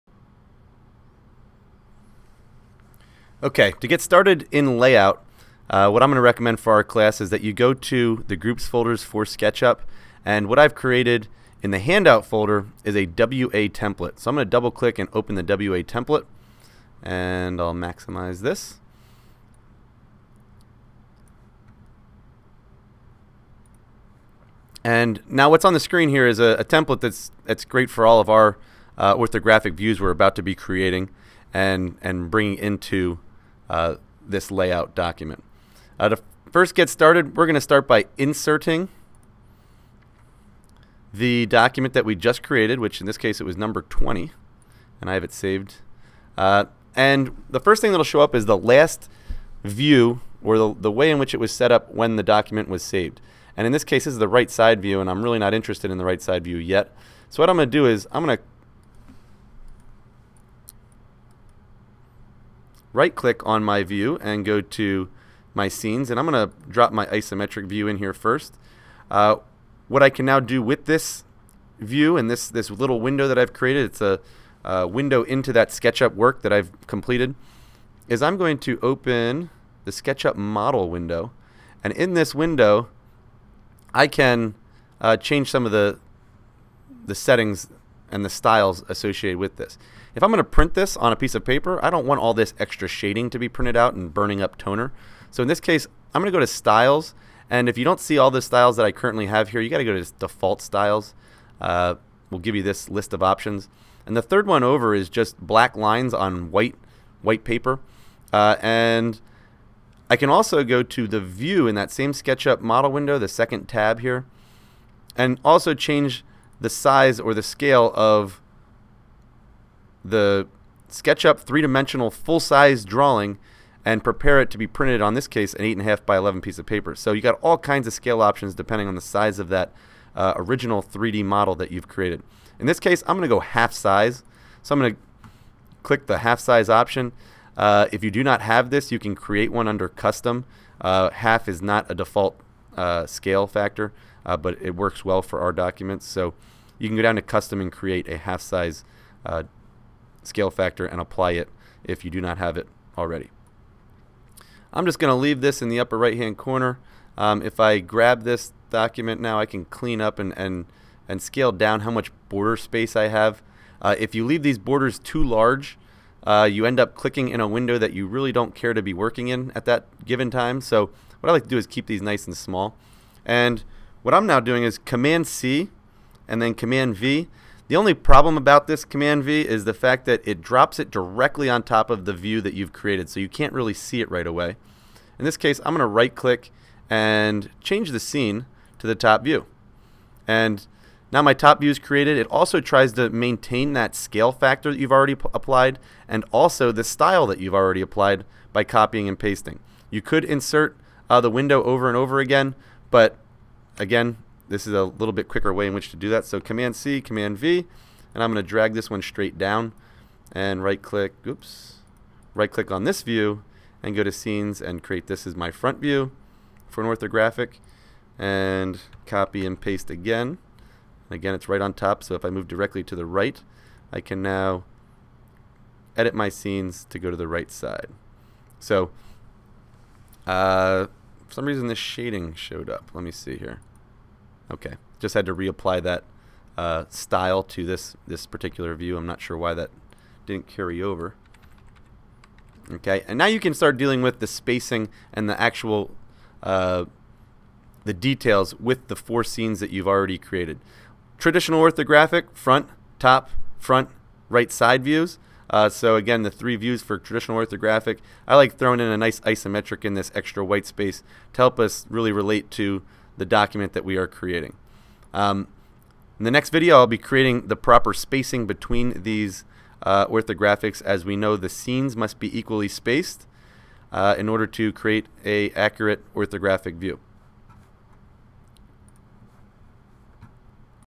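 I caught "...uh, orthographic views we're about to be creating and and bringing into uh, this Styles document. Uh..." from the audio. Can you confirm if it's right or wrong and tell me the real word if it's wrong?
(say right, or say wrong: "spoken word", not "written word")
wrong: "LayOut", not "Styles".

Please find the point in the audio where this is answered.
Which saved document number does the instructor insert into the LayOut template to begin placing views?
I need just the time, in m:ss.
0:43.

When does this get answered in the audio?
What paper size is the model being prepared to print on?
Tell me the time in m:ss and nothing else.
2:05.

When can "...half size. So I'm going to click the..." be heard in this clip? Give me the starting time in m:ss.
2:13.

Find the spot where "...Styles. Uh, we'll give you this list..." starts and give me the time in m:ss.
1:40.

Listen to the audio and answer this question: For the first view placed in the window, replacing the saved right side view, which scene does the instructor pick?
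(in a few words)
Isometric view.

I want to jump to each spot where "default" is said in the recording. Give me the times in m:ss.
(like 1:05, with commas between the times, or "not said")
1:40, 2:21.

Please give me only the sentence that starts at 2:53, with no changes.
And what I'm now doing is Command C and then Command V.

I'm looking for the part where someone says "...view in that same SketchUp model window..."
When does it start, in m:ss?
1:51.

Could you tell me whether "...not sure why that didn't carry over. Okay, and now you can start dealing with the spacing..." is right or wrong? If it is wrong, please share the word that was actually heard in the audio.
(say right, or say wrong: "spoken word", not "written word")
right.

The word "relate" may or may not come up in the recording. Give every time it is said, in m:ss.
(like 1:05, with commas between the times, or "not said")
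4:22.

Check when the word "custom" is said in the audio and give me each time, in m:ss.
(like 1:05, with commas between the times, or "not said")
2:19, 2:27.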